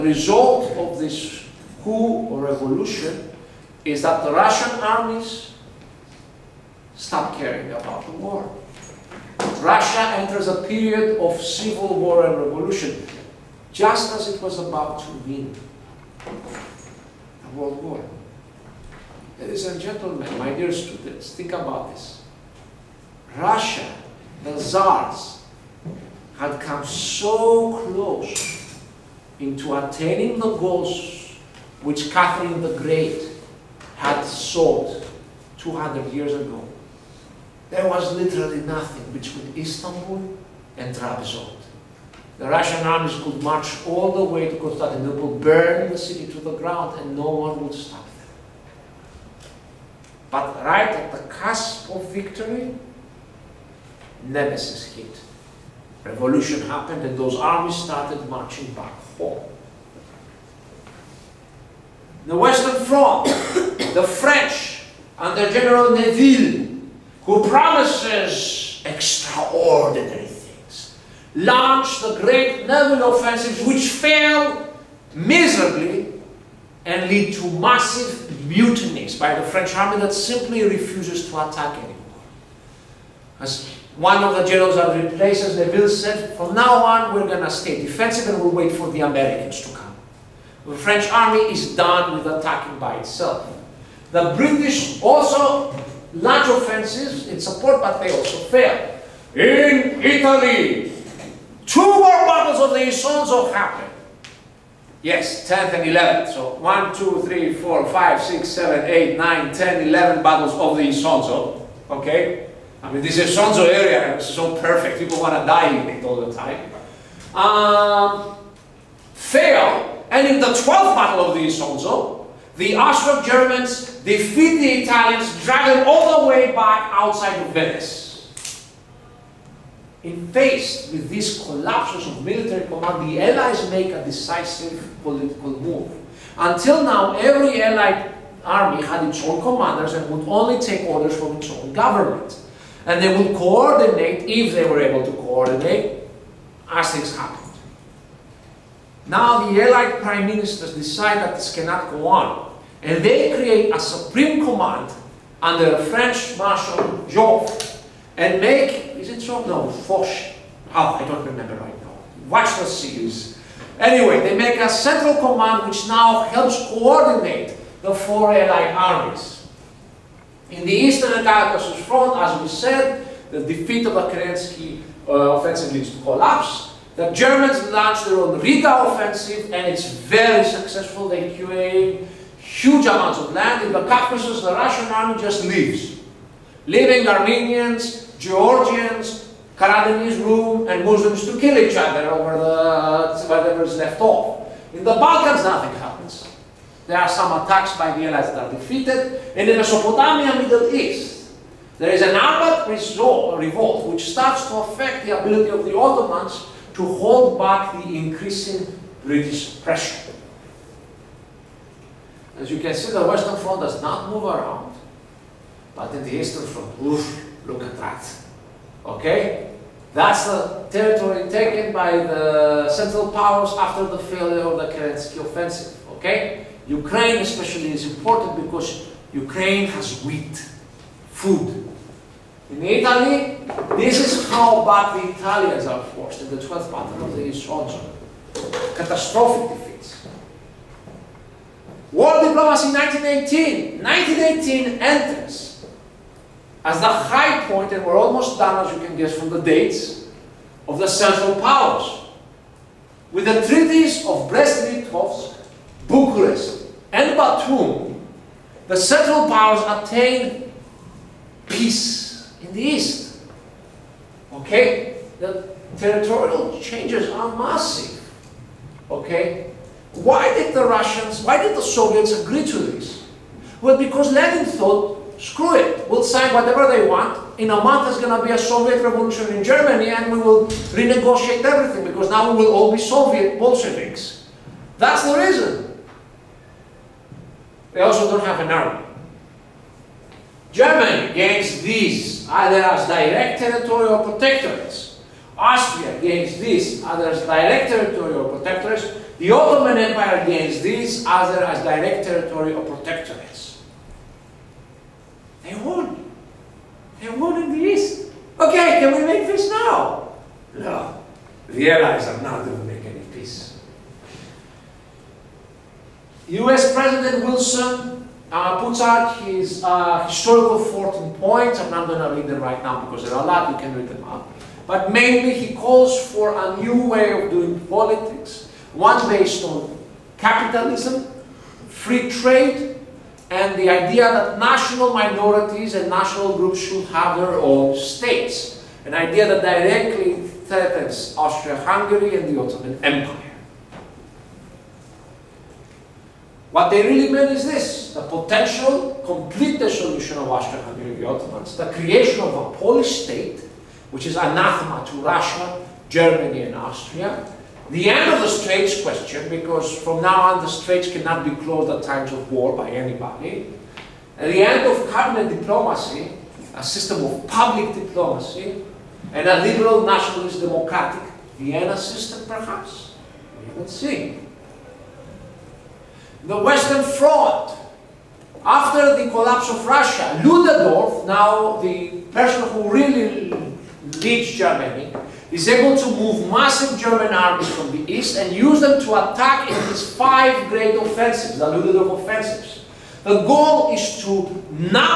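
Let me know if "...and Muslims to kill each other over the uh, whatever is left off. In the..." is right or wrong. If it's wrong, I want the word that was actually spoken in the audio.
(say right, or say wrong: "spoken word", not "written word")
right.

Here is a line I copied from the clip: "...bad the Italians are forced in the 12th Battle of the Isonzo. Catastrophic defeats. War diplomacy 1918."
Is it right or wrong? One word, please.
right.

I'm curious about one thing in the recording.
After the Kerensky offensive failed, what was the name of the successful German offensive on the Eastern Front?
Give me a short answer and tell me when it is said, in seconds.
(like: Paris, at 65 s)
Riga offensive, at 178 s.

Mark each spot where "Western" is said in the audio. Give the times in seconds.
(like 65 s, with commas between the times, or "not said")
62 s, 213 s, 376 s.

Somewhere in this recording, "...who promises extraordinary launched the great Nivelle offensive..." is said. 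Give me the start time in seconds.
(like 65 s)
67 s.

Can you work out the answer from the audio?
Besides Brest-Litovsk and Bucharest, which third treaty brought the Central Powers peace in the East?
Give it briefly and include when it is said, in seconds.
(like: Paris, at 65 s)
Batum, at 257 s.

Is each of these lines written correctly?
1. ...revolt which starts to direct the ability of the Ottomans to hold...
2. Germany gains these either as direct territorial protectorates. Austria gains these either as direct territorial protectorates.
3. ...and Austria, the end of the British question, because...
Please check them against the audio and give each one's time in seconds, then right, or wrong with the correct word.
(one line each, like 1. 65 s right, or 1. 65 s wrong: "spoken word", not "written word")
1. 202 s wrong: "affect", not "direct"
2. 290 s right
3. 356 s wrong: "Straits", not "British".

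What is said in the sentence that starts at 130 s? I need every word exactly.
And faced with these collapses of military command, the Allies make a decisive political move.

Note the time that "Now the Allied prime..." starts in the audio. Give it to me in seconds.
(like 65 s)
149 s.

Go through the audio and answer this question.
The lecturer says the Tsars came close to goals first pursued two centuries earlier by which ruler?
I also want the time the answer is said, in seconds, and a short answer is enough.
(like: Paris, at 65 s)
Catherine the Great, at 32 s.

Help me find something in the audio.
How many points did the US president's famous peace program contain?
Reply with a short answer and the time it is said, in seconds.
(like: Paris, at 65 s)
14, at 320 s.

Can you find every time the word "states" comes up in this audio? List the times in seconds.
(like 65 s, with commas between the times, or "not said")
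337 s, 353 s.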